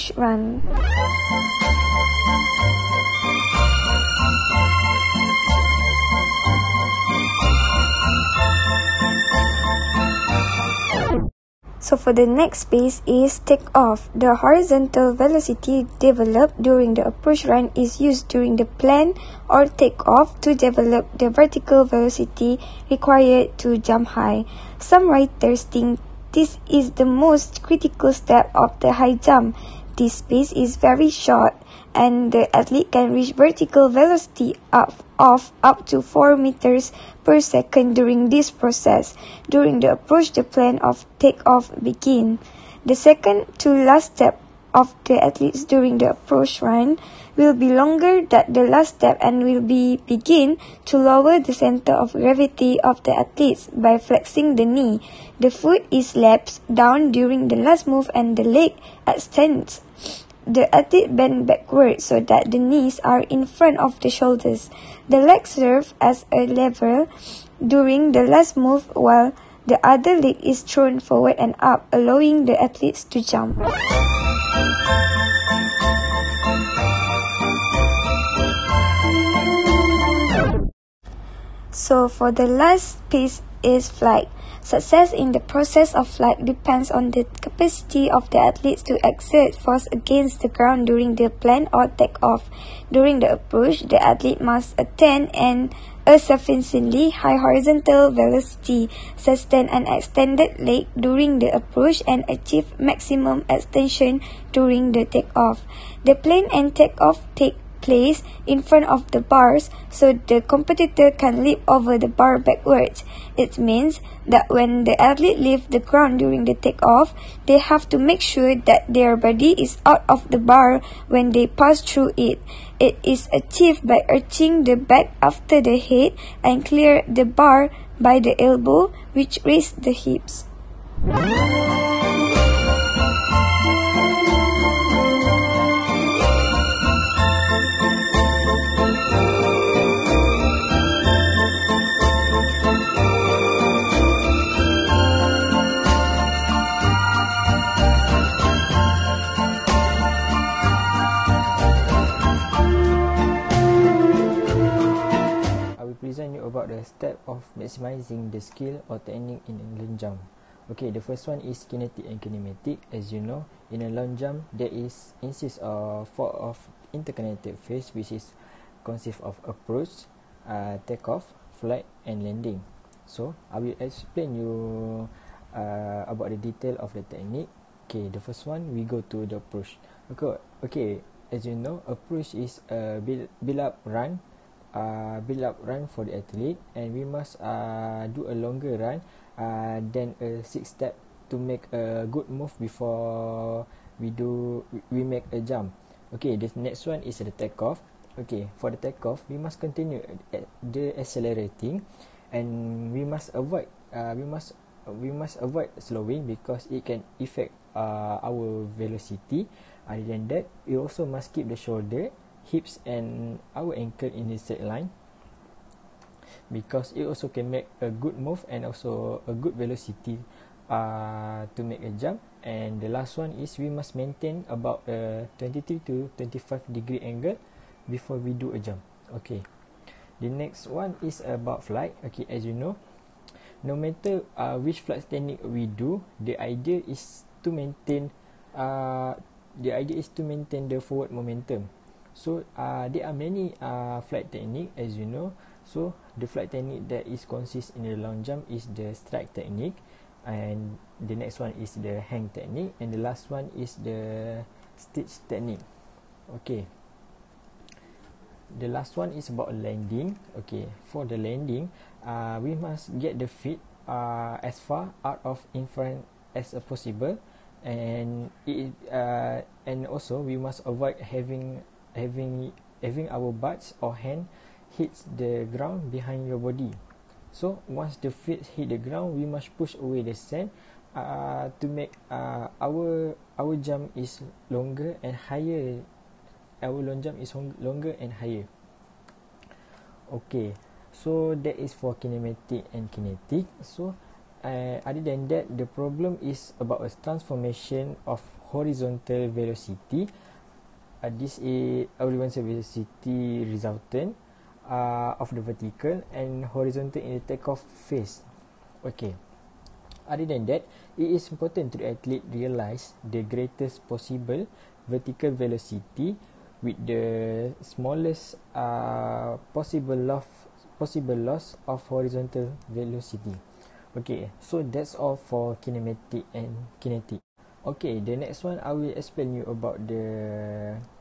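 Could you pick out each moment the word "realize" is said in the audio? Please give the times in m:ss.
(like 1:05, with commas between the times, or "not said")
5:12.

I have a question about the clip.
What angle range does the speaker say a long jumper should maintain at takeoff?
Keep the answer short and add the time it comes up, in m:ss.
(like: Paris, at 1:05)
23 to 25 degrees, at 3:45.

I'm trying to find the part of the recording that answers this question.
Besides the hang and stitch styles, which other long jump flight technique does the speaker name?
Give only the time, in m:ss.
4:08.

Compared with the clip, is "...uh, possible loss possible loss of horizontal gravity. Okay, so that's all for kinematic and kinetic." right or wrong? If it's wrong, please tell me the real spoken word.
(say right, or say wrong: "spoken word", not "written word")
wrong: "velocity", not "gravity".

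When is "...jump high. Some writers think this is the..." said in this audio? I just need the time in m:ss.
0:23.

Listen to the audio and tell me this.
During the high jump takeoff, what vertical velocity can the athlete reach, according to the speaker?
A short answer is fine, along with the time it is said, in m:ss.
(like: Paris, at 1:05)
4 meters per second, at 0:36.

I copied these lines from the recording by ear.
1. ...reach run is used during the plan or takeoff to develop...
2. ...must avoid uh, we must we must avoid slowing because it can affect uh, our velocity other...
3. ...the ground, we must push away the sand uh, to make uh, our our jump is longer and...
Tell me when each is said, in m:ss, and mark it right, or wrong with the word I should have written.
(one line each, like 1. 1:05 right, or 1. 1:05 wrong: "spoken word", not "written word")
1. 0:17 wrong: "approach", not "reach"
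2. 3:23 right
3. 4:38 right.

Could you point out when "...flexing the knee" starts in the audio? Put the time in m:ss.
0:53.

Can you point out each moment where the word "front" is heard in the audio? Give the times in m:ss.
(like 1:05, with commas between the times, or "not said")
1:03, 1:48, 4:25.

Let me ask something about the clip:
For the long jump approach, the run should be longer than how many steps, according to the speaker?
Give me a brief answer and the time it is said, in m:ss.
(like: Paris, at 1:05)
six, at 3:10.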